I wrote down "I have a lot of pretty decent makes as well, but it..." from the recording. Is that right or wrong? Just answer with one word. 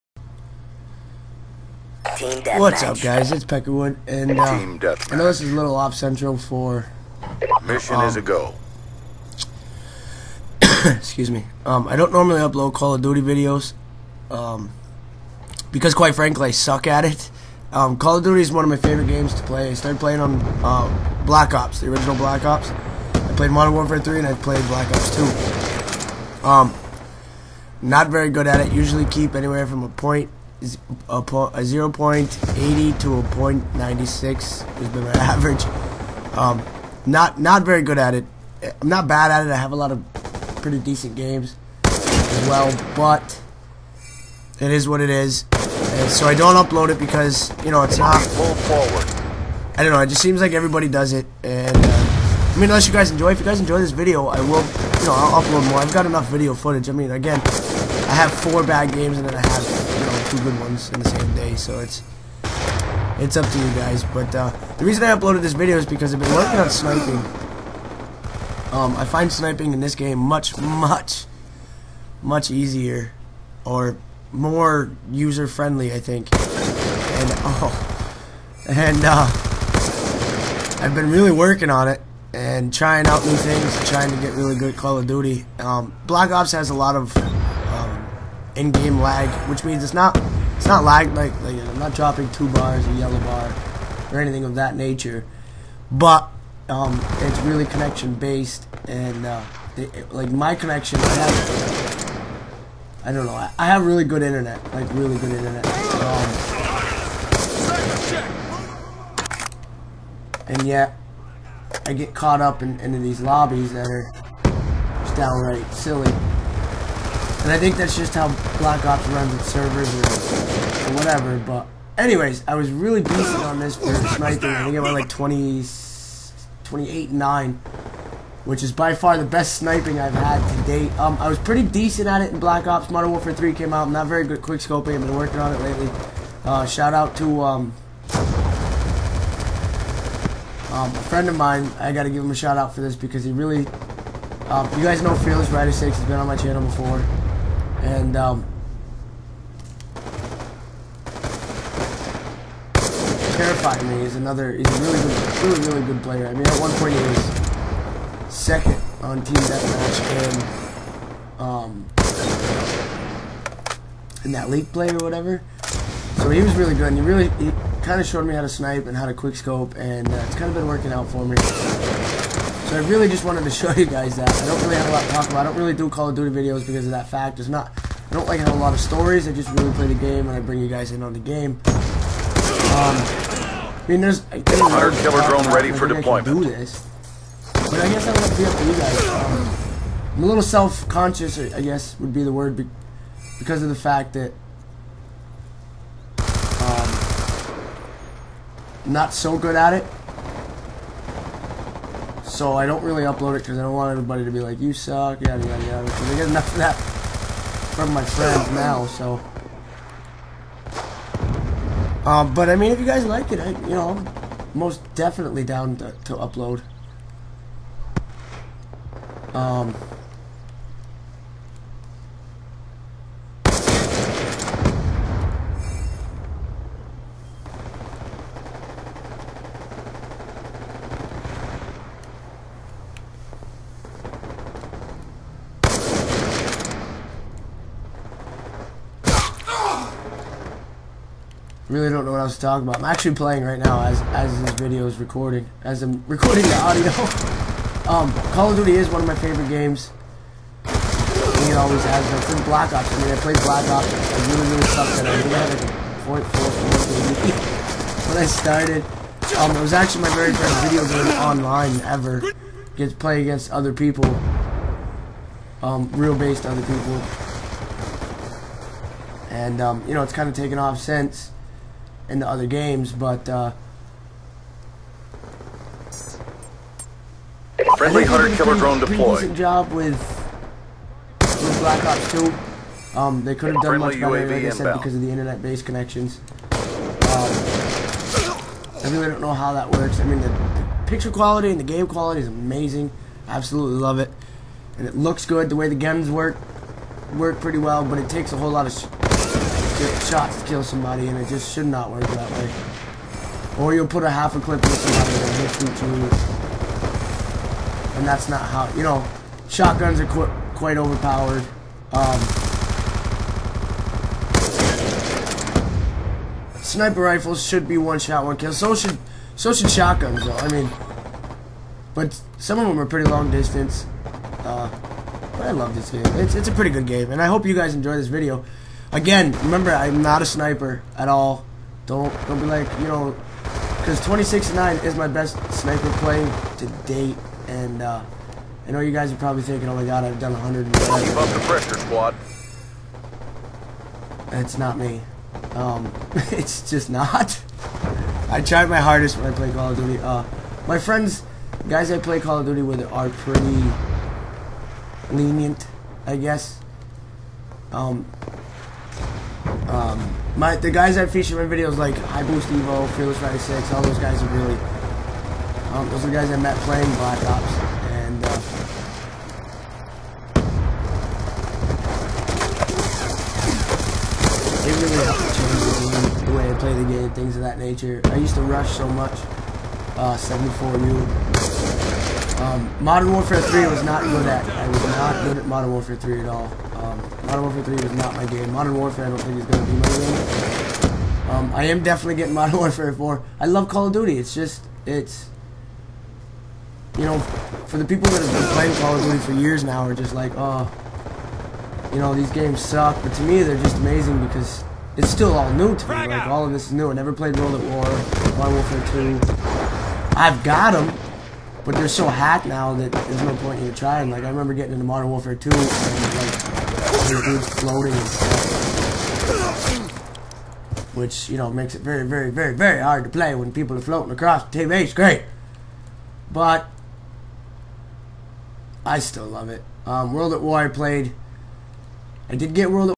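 wrong.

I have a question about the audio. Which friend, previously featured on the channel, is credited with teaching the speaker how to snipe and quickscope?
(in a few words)
Fearless Rider 6.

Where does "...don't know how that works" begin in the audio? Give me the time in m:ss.
4:49.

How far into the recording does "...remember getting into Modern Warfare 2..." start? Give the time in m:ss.
6:54.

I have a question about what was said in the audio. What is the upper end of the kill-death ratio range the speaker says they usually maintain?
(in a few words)
0.96.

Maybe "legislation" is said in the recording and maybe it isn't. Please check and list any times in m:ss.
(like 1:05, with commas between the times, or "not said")
not said.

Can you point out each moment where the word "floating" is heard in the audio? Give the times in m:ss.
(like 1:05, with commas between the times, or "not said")
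6:57, 7:03.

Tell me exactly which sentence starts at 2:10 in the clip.
Um, I was pretty decent at it in Black Ops.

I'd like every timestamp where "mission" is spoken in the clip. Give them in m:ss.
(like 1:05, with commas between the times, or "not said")
0:07.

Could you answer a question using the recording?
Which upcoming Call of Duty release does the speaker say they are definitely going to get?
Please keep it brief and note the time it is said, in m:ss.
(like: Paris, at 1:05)
Modern Warfare 4, at 6:32.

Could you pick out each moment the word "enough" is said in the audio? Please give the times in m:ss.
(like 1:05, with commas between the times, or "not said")
0:56, 3:26.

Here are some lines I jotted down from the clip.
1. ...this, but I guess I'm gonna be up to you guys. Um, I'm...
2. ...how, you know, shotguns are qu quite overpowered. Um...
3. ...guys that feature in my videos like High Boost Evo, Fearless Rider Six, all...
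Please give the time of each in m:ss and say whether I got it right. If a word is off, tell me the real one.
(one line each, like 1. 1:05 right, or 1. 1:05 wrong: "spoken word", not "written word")
1. 3:06 right
2. 5:08 right
3. 6:00 right.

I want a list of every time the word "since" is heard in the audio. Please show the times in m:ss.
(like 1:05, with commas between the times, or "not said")
4:12, 4:30.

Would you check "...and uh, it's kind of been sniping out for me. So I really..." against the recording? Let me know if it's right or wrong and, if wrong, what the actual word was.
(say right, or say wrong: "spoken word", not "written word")
wrong: "working", not "sniping".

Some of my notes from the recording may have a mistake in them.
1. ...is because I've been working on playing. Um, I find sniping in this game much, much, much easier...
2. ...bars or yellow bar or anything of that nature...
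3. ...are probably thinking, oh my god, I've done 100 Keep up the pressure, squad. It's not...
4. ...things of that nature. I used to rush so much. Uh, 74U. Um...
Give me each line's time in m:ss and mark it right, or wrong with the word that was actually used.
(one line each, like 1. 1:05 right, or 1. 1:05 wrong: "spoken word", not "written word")
1. 1:05 wrong: "sniping", not "playing"
2. 1:32 right
3. 5:39 right
4. 6:17 right.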